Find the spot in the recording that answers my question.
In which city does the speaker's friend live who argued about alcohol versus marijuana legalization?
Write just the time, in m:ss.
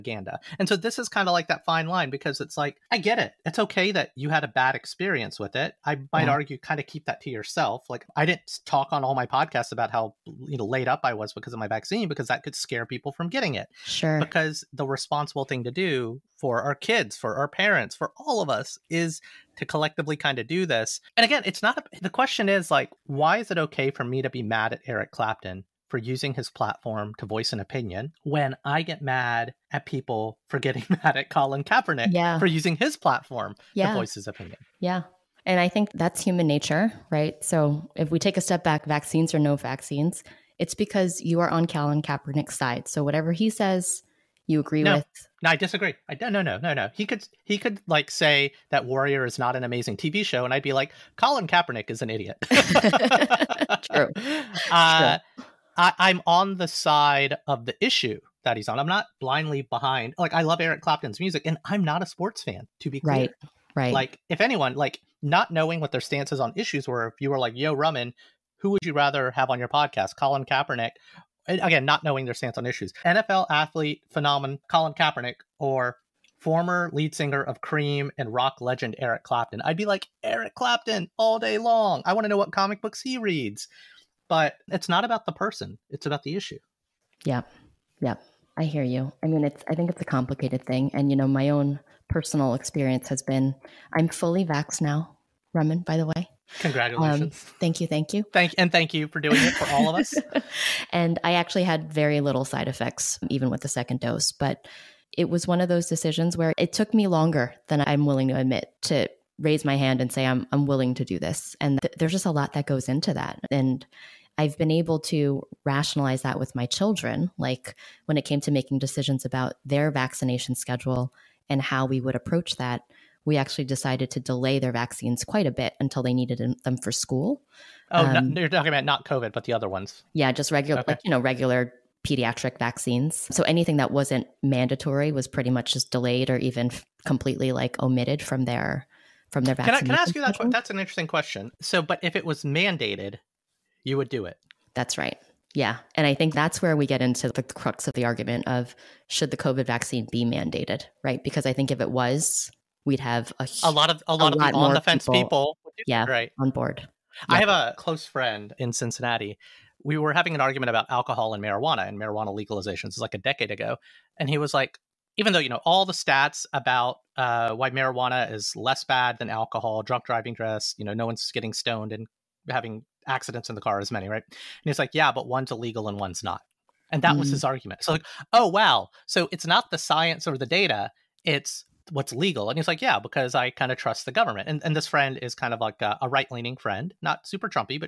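2:38.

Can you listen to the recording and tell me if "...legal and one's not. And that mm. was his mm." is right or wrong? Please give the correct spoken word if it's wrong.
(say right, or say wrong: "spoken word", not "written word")
wrong: "illegal", not "legal".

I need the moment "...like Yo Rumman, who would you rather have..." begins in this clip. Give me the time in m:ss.
1:07.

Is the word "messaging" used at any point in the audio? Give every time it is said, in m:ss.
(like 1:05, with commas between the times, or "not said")
not said.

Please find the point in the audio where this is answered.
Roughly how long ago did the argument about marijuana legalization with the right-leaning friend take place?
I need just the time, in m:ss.
2:43.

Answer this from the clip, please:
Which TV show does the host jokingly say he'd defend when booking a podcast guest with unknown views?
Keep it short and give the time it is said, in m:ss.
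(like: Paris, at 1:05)
Warrior, at 0:48.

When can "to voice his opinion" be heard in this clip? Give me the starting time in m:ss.
0:33.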